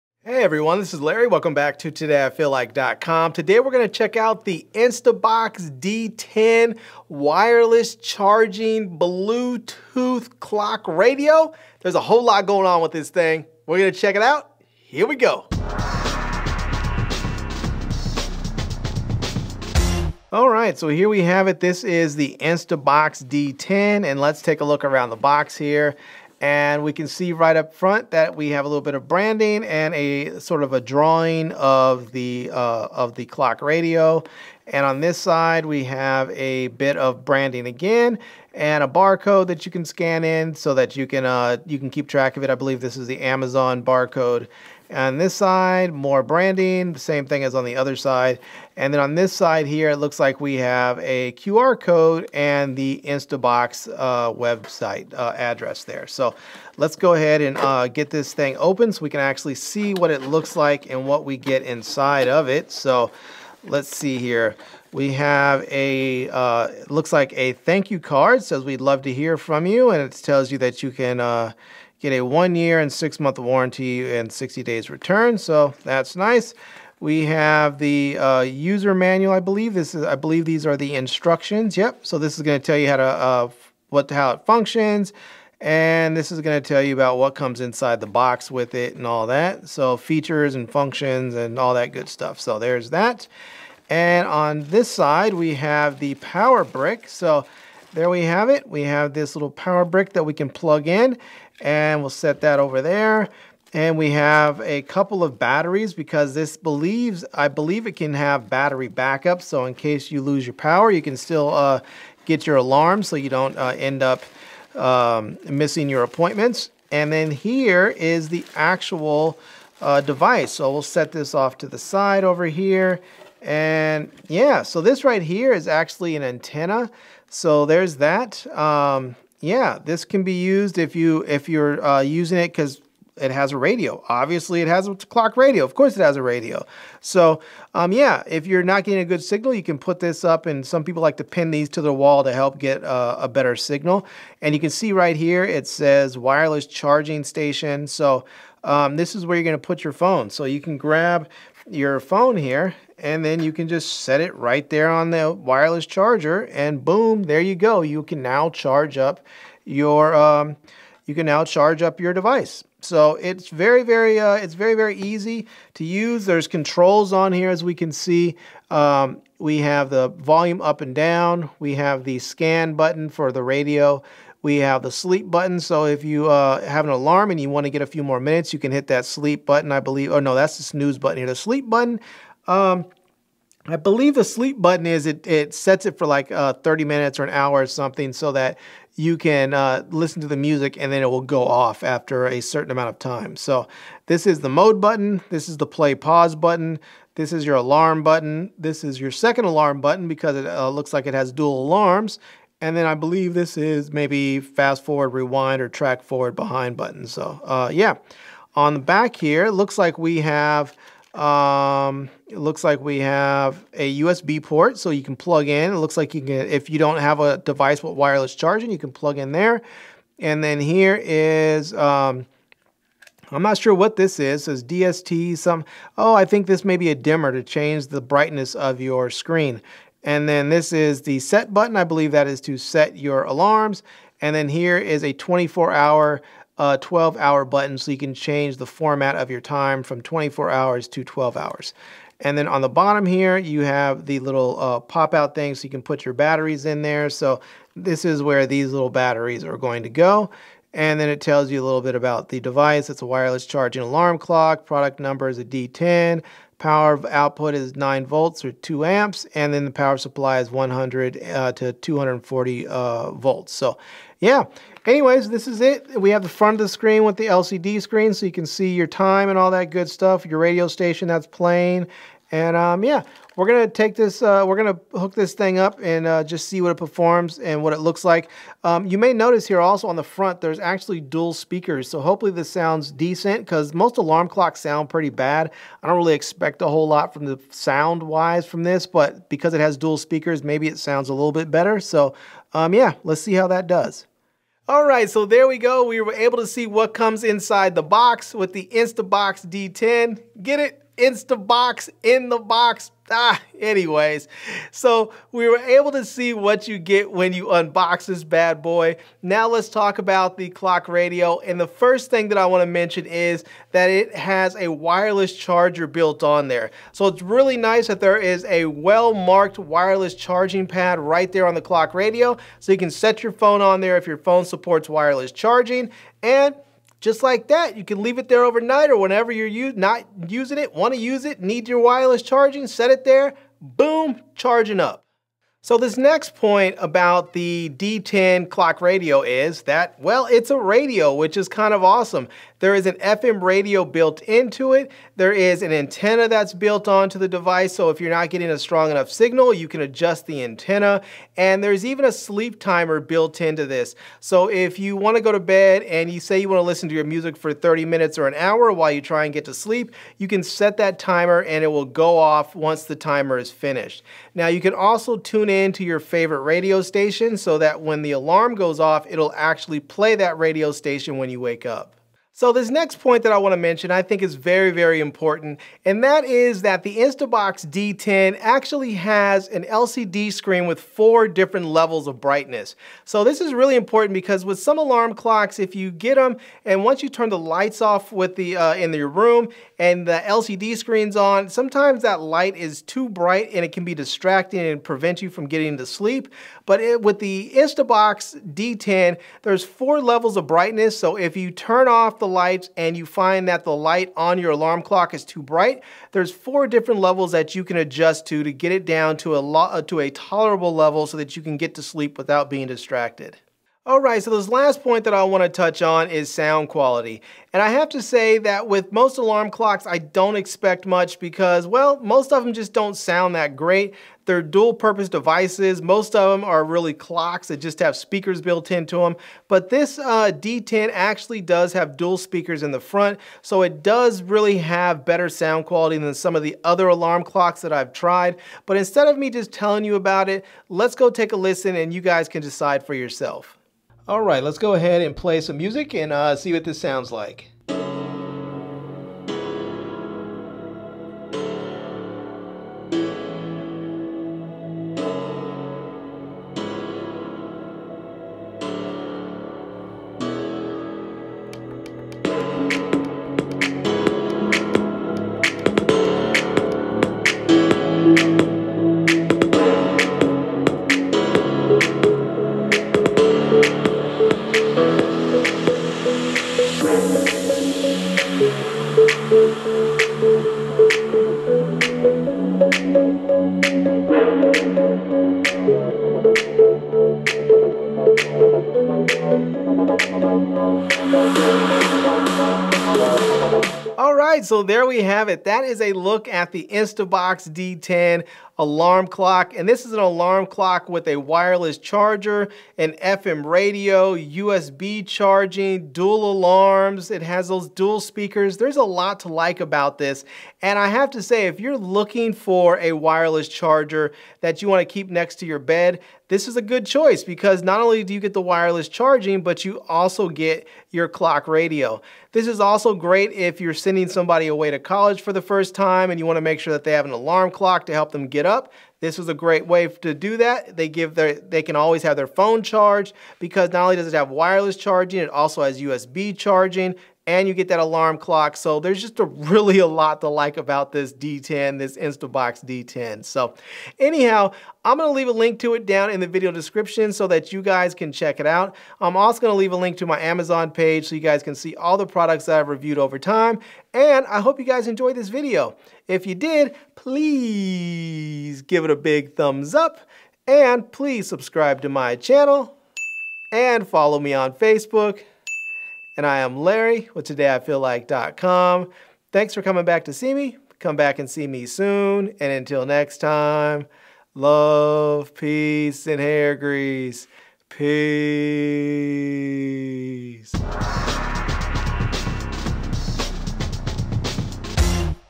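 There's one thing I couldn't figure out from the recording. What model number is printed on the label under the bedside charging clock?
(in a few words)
D10.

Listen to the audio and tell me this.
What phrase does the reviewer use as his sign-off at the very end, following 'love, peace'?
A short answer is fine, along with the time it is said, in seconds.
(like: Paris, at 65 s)
hair grease, at 576 s.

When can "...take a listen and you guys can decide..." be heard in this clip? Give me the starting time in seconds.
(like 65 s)
441 s.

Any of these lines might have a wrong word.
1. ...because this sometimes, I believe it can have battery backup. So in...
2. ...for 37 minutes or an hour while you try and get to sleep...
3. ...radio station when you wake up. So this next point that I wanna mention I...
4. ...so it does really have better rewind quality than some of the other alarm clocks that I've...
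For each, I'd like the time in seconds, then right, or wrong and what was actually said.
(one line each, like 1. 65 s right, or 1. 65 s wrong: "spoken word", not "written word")
1. 105 s wrong: "believes", not "sometimes"
2. 357 s wrong: "30", not "37"
3. 370 s right
4. 433 s wrong: "sound", not "rewind".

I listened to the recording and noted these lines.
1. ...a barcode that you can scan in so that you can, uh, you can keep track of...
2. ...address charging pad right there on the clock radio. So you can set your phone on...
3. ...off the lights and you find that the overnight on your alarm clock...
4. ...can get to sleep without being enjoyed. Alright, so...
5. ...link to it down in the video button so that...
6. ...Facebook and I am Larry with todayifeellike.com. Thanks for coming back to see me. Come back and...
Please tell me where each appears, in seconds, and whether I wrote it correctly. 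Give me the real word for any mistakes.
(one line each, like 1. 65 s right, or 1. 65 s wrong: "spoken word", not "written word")
1. 38 s right
2. 319 s wrong: "wireless", not "address"
3. 401 s wrong: "light", not "overnight"
4. 411 s wrong: "distracted", not "enjoyed"
5. 545 s wrong: "description", not "button"
6. 564 s right.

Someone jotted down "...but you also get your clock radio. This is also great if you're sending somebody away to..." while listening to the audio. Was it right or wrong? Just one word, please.
right.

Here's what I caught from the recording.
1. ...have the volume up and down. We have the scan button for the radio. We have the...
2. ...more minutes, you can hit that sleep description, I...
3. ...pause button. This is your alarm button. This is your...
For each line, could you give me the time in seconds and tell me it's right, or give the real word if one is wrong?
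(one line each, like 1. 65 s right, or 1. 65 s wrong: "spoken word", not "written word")
1. 169 s right
2. 178 s wrong: "button", not "description"
3. 195 s right.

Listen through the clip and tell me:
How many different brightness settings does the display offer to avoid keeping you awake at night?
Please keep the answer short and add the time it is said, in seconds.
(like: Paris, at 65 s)
4, at 380 s.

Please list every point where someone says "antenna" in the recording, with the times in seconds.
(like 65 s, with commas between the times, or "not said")
126 s, 345 s, 350 s.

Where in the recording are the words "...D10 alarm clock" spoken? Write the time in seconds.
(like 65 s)
497 s.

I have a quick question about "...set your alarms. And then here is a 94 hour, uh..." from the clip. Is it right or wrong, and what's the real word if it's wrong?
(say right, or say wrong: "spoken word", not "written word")
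wrong: "24", not "94".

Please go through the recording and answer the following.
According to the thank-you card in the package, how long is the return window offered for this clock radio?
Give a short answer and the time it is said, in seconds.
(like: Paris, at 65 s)
60 days, at 74 s.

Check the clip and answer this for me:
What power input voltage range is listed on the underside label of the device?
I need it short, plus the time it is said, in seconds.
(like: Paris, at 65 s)
100 to 240 volts, at 260 s.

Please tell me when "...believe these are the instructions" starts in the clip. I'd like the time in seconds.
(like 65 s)
80 s.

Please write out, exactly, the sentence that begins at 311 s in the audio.
And the first thing that I want to mention is that it has a wireless charger built on there.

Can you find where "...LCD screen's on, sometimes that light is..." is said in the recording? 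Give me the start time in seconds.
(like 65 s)
390 s.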